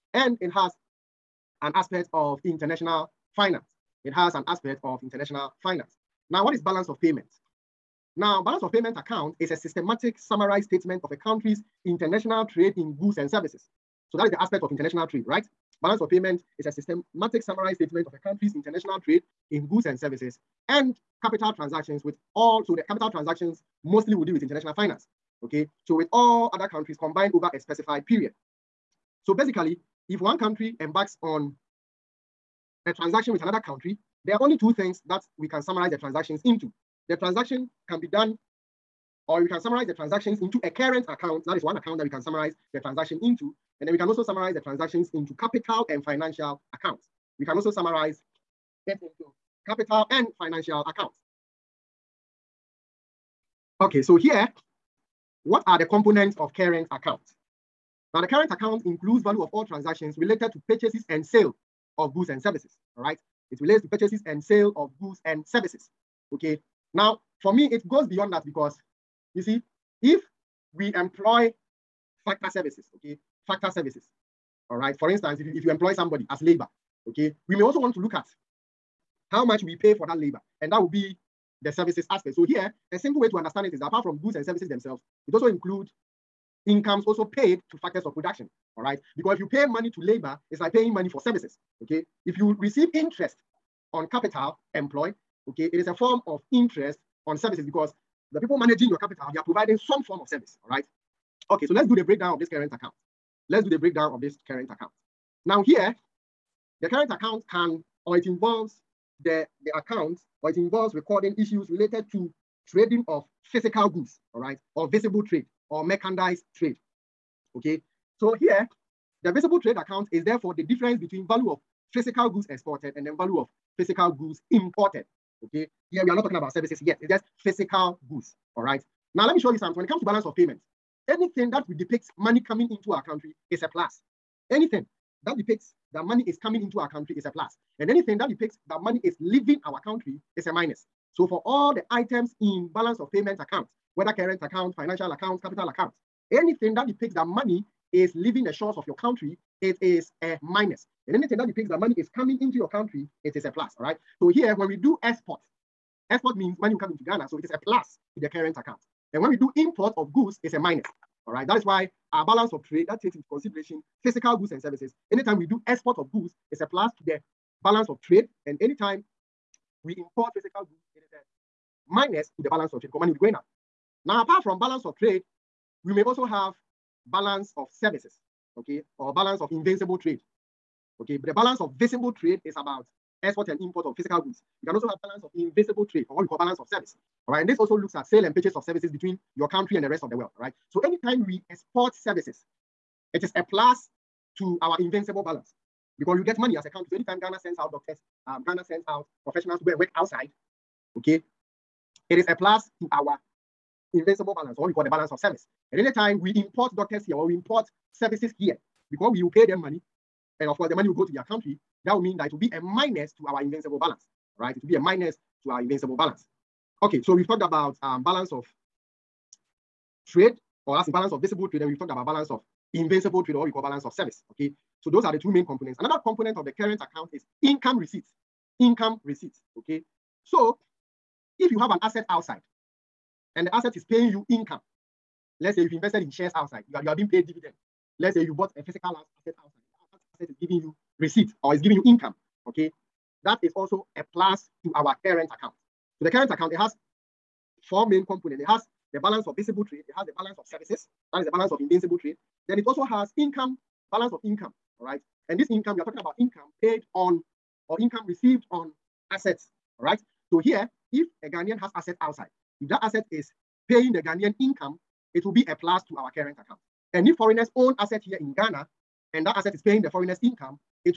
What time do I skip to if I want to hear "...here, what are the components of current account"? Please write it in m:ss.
0:54.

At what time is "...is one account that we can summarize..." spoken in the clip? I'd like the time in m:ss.
0:41.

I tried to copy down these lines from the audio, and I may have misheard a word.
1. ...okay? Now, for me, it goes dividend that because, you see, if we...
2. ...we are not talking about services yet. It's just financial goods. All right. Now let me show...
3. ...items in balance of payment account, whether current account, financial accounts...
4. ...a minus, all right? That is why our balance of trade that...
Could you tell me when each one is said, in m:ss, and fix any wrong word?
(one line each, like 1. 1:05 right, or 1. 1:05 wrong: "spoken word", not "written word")
1. 1:06 wrong: "beyond", not "dividend"
2. 2:06 wrong: "physical", not "financial"
3. 2:21 right
4. 2:40 right.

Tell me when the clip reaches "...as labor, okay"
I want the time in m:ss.
1:16.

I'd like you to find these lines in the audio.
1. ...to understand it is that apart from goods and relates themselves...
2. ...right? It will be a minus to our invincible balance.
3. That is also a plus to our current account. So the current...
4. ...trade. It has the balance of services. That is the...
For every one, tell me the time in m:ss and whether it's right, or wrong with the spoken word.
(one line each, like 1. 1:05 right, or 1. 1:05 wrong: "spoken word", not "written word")
1. 1:23 wrong: "services", not "relates"
2. 3:34 right
3. 4:03 right
4. 4:09 right.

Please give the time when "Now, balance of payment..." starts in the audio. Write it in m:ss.
0:08.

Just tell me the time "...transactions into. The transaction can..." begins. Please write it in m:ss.
0:35.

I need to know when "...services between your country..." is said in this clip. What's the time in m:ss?
3:08.